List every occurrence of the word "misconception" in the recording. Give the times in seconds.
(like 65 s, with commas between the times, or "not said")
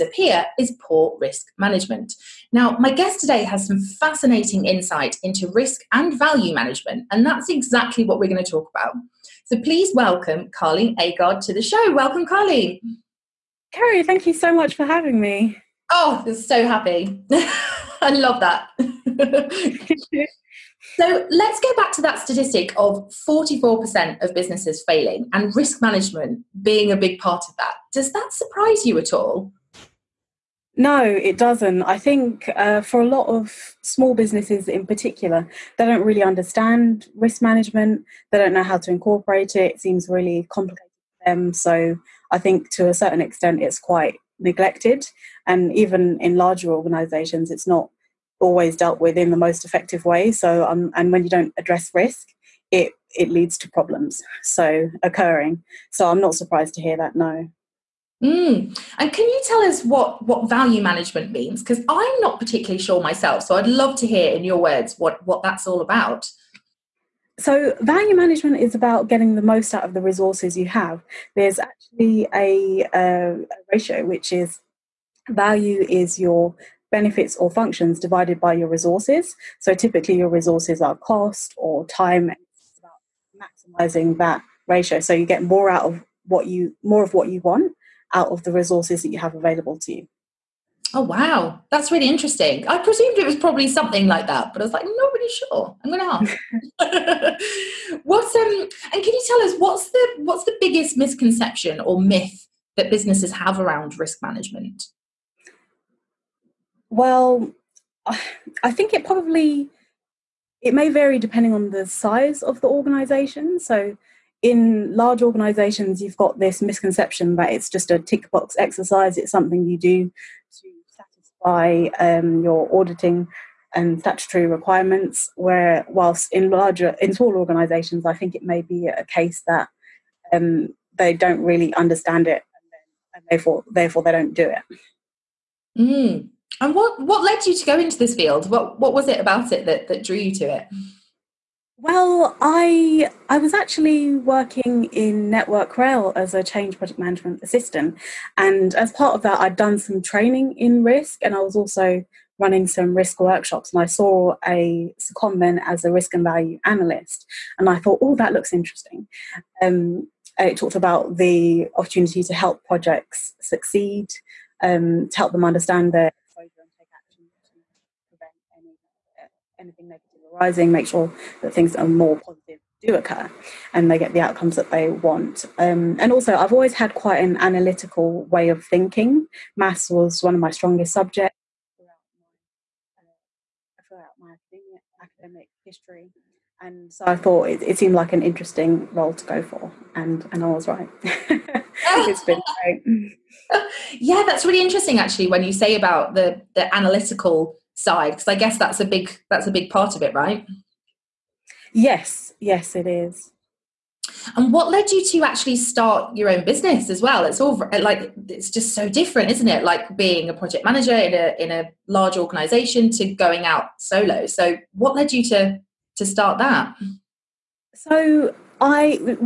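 100 s, 116 s.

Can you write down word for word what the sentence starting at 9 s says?
So please welcome Karlene Agard to the show.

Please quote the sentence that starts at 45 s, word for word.
And even in larger organizations, it's not always dealt with in the most effective way.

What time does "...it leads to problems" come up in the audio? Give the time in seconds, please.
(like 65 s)
53 s.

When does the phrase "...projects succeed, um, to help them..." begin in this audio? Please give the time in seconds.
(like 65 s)
162 s.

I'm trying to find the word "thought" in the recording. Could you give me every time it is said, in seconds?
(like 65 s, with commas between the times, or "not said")
157 s, 187 s.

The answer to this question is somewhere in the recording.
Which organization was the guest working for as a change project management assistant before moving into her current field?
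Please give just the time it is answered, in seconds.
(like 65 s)
145 s.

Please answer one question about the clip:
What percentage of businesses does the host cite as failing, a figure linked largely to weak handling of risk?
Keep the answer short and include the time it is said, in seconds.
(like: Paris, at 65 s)
44%, at 23 s.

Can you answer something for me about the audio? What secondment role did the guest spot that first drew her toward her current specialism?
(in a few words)
Risk and value analyst.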